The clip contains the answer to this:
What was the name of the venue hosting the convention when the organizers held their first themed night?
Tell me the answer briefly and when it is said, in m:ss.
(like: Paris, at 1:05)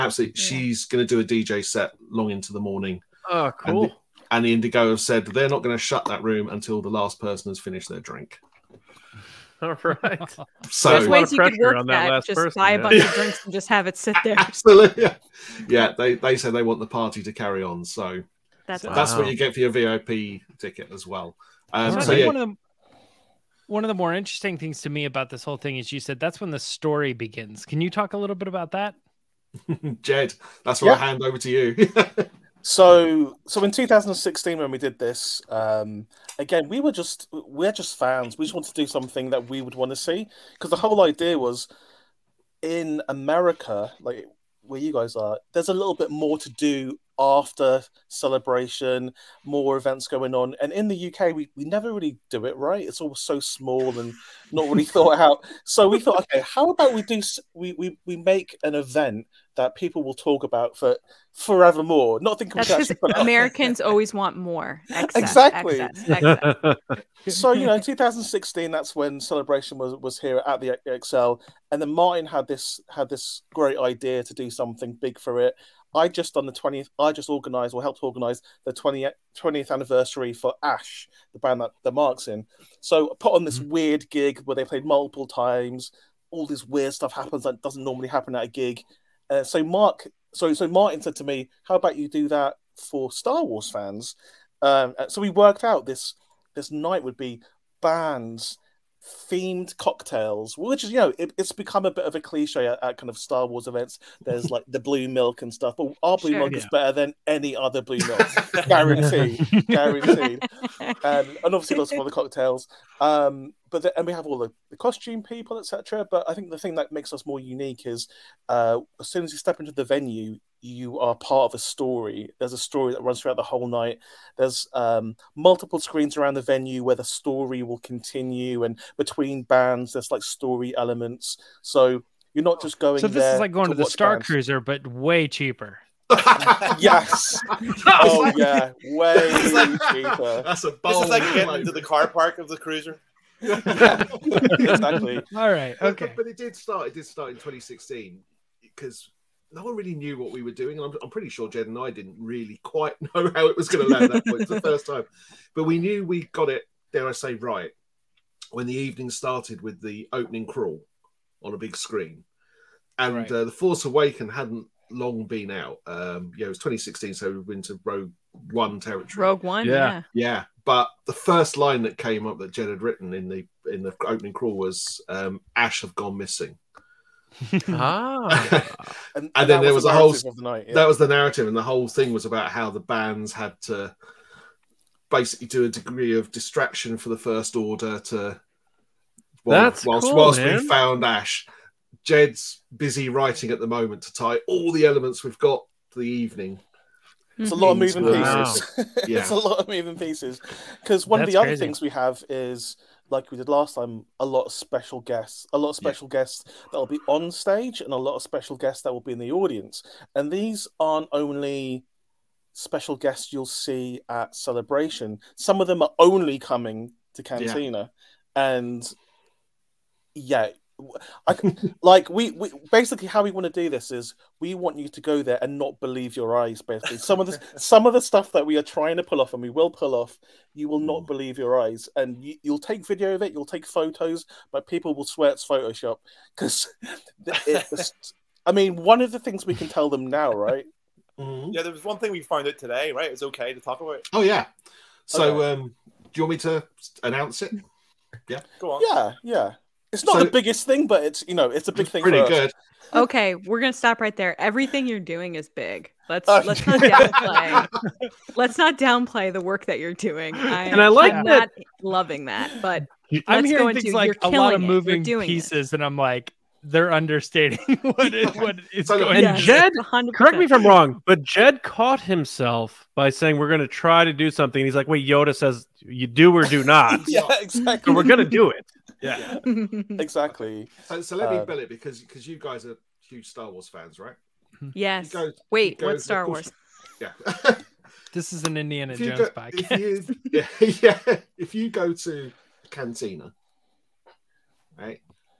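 ExCeL, at 1:10.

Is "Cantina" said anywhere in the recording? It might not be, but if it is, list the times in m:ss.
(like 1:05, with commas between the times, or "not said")
3:37, 4:52.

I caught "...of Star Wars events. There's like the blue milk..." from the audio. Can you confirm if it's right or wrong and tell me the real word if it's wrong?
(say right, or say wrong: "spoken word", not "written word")
right.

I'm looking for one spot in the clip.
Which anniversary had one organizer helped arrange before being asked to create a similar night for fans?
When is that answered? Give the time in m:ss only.
1:19.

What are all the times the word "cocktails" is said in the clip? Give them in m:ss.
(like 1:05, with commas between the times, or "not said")
1:39, 1:52.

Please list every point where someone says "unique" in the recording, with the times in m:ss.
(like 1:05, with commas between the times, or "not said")
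1:57.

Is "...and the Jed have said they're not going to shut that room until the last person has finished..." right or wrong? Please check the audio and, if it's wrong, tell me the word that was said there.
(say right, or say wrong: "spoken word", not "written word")
wrong: "Indigo", not "Jed".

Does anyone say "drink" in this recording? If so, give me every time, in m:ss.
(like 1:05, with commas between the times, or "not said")
0:08, 0:13.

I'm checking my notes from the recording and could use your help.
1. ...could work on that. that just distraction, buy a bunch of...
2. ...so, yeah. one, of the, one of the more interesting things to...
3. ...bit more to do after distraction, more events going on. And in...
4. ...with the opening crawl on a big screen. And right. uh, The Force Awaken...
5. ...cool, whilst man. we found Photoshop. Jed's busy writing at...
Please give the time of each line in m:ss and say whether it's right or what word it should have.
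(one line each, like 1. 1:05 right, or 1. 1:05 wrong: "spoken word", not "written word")
1. 0:11 wrong: "person", not "distraction"
2. 0:22 right
3. 0:45 wrong: "celebration", not "distraction"
4. 2:39 right
5. 3:10 wrong: "Ash", not "Photoshop".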